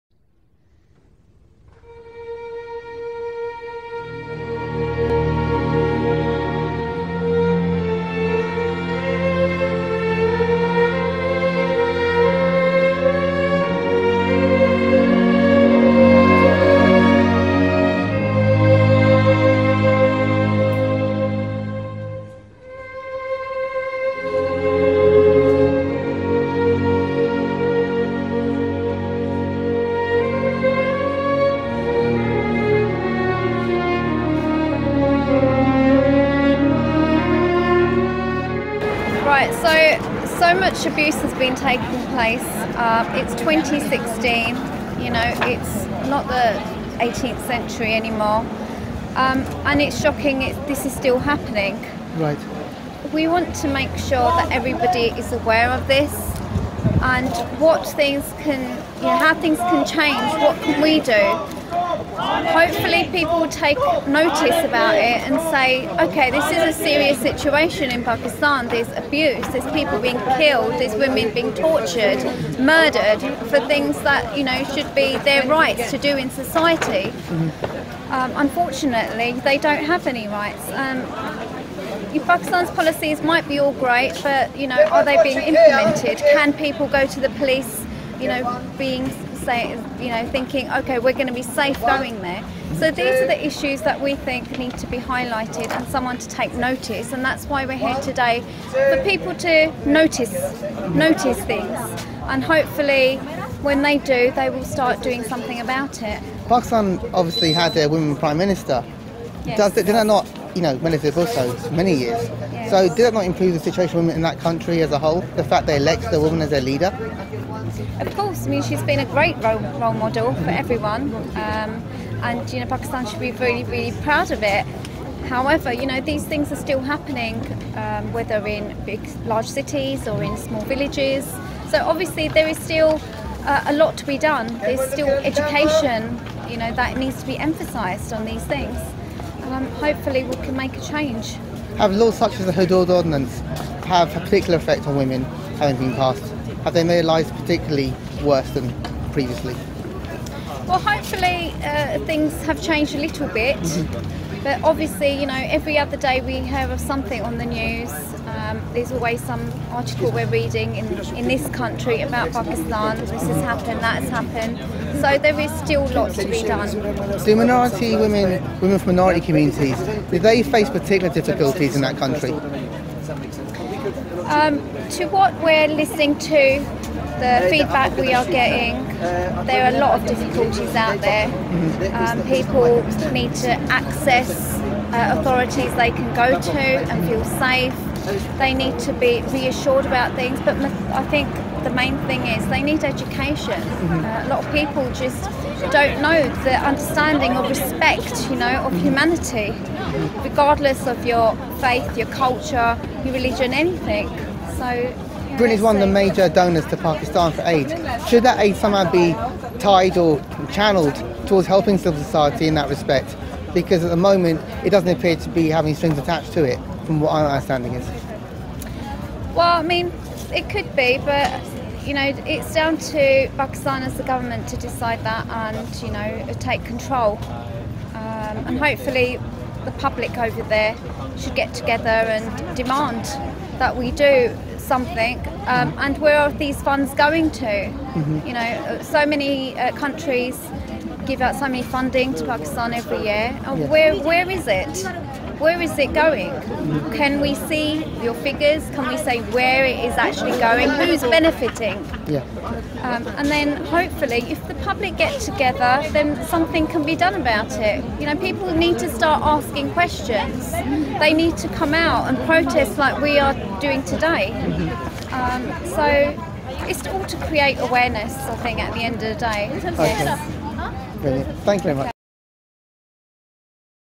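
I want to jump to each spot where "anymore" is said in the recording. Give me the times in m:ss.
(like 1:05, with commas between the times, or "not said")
0:47.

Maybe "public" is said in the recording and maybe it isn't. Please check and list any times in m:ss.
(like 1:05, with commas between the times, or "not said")
3:49, 4:14.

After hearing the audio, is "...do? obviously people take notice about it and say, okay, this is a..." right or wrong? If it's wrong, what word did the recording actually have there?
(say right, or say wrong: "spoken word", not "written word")
wrong: "hopefully", not "obviously".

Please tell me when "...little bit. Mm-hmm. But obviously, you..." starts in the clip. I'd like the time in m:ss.
2:32.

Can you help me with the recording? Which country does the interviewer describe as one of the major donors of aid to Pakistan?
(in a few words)
Britain.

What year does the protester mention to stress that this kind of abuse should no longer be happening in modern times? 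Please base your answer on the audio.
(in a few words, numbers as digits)
2016.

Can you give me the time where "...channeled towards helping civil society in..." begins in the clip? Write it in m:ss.
3:30.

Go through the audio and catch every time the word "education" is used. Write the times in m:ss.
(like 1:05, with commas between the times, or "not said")
2:15, 3:12.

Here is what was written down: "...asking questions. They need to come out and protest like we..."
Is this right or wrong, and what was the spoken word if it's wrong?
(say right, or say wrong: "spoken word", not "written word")
right.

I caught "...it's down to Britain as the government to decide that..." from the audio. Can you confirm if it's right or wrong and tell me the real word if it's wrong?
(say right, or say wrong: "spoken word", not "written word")
wrong: "Pakistan", not "Britain".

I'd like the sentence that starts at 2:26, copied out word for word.
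Have they made lives particularly worse than previously?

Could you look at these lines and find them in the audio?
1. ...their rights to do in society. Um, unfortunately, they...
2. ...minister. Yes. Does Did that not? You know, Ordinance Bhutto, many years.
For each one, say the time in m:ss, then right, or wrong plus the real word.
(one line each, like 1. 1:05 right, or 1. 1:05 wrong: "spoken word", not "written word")
1. 1:15 right
2. 1:48 wrong: "Benazir", not "Ordinance".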